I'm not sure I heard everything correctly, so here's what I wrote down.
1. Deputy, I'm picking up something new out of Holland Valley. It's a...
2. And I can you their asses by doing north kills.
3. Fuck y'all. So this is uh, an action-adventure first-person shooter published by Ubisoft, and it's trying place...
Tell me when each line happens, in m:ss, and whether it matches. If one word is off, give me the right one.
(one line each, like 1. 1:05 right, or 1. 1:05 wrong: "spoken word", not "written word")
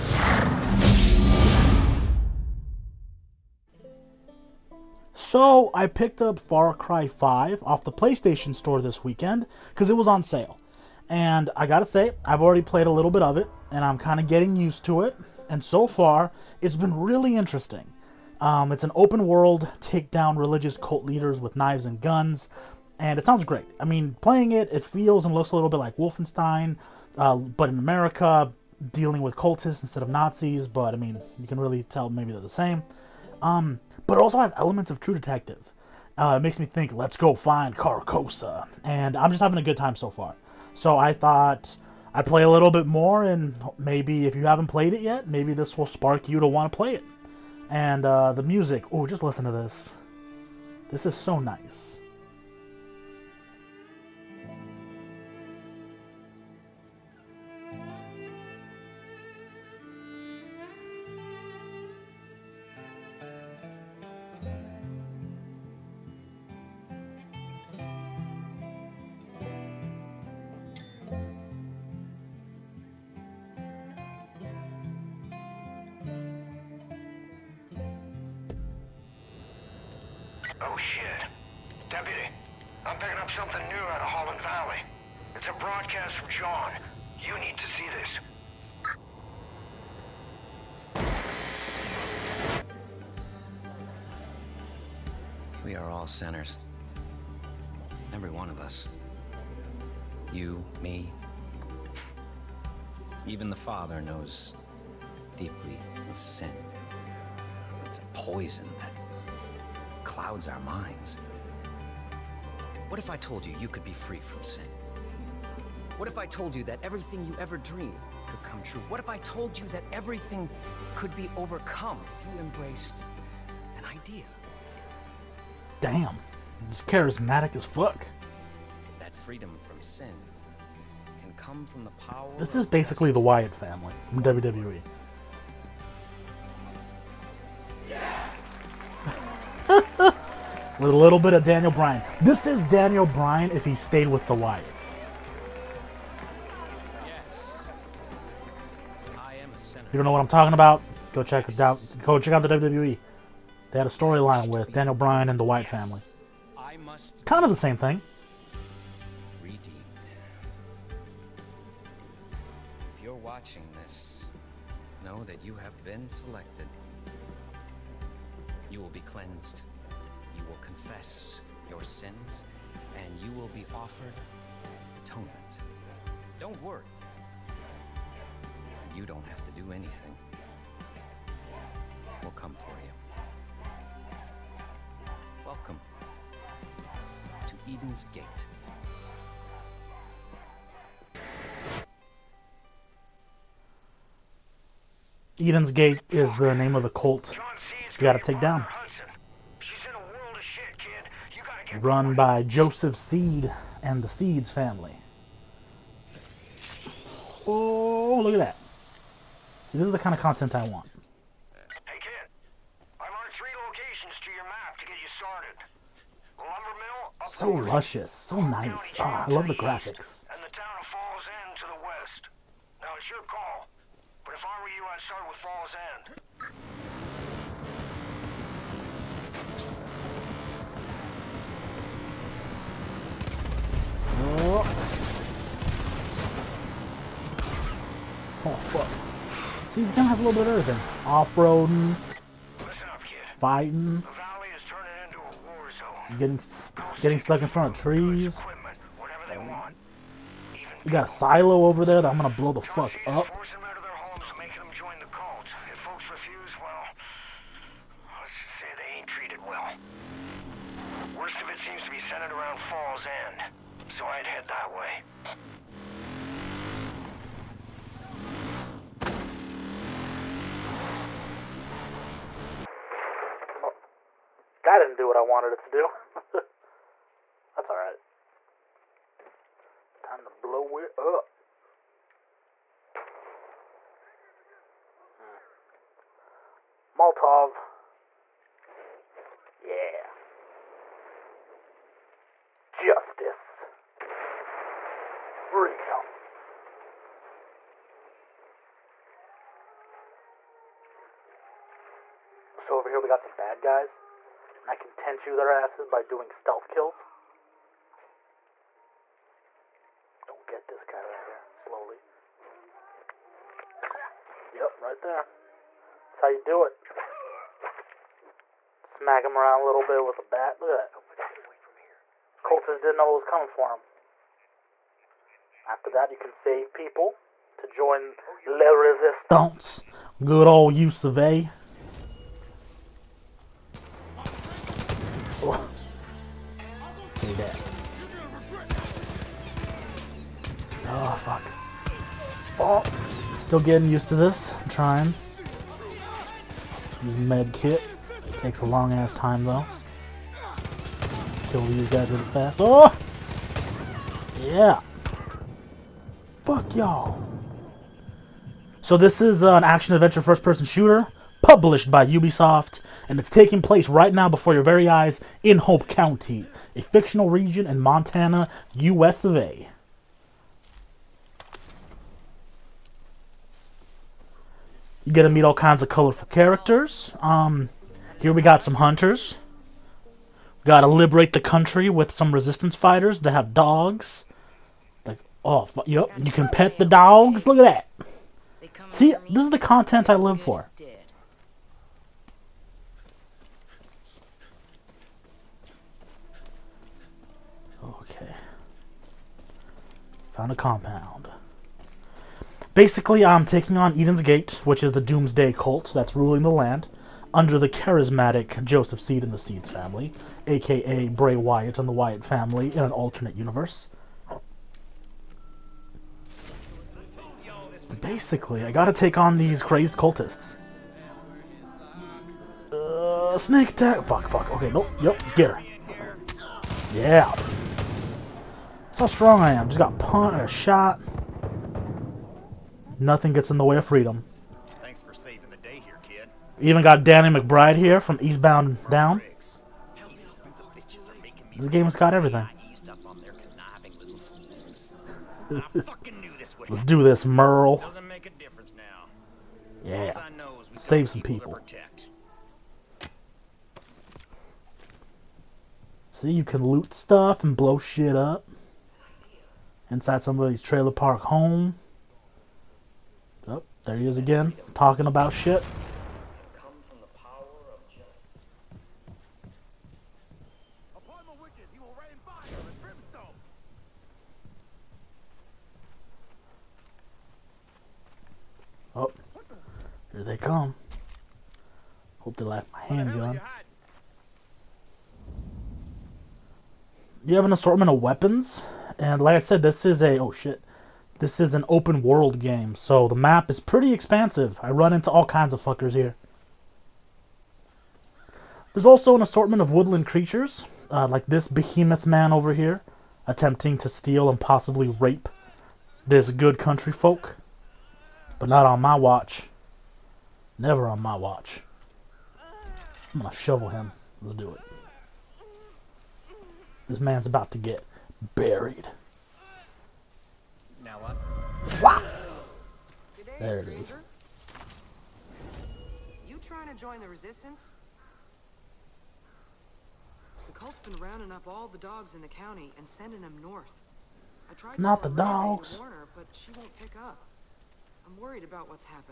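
1. 1:21 right
2. 5:04 wrong: "stealth", not "north"
3. 5:56 wrong: "taking", not "trying".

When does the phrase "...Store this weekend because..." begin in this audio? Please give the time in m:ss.
0:08.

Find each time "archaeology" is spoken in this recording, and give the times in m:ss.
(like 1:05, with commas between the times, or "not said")
not said.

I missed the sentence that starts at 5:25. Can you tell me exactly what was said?
After that, you can save people to join oh, Le Resistance.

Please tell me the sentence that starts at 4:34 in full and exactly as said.
That didn't do what I wanted it to do.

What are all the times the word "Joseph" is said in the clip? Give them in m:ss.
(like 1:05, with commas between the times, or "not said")
3:22, 6:48.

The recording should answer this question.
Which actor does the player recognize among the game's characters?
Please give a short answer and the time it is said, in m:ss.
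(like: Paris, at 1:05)
Danny McBride, at 7:17.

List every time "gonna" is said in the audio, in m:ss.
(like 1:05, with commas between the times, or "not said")
4:12, 8:33.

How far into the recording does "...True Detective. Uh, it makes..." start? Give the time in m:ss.
0:35.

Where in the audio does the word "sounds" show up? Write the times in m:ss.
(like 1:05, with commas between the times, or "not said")
0:23.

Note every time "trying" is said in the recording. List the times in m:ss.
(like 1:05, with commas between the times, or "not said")
5:44, 8:46.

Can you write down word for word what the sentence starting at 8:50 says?
The cult's been rounding up all the dogs in the county and sending them north.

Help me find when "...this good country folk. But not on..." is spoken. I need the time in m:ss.
8:26.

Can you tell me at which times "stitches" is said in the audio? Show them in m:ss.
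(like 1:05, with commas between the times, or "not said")
not said.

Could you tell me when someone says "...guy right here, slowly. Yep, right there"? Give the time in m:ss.
5:10.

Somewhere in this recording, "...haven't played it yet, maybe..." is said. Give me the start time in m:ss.
0:44.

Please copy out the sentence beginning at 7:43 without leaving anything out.
Oh, there he is again, talking about shit.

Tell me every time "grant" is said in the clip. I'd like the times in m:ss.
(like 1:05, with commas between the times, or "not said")
not said.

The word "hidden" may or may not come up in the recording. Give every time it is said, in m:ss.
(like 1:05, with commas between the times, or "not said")
not said.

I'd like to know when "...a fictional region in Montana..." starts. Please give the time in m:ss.
6:06.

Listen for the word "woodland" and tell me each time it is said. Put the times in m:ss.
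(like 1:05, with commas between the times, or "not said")
8:19.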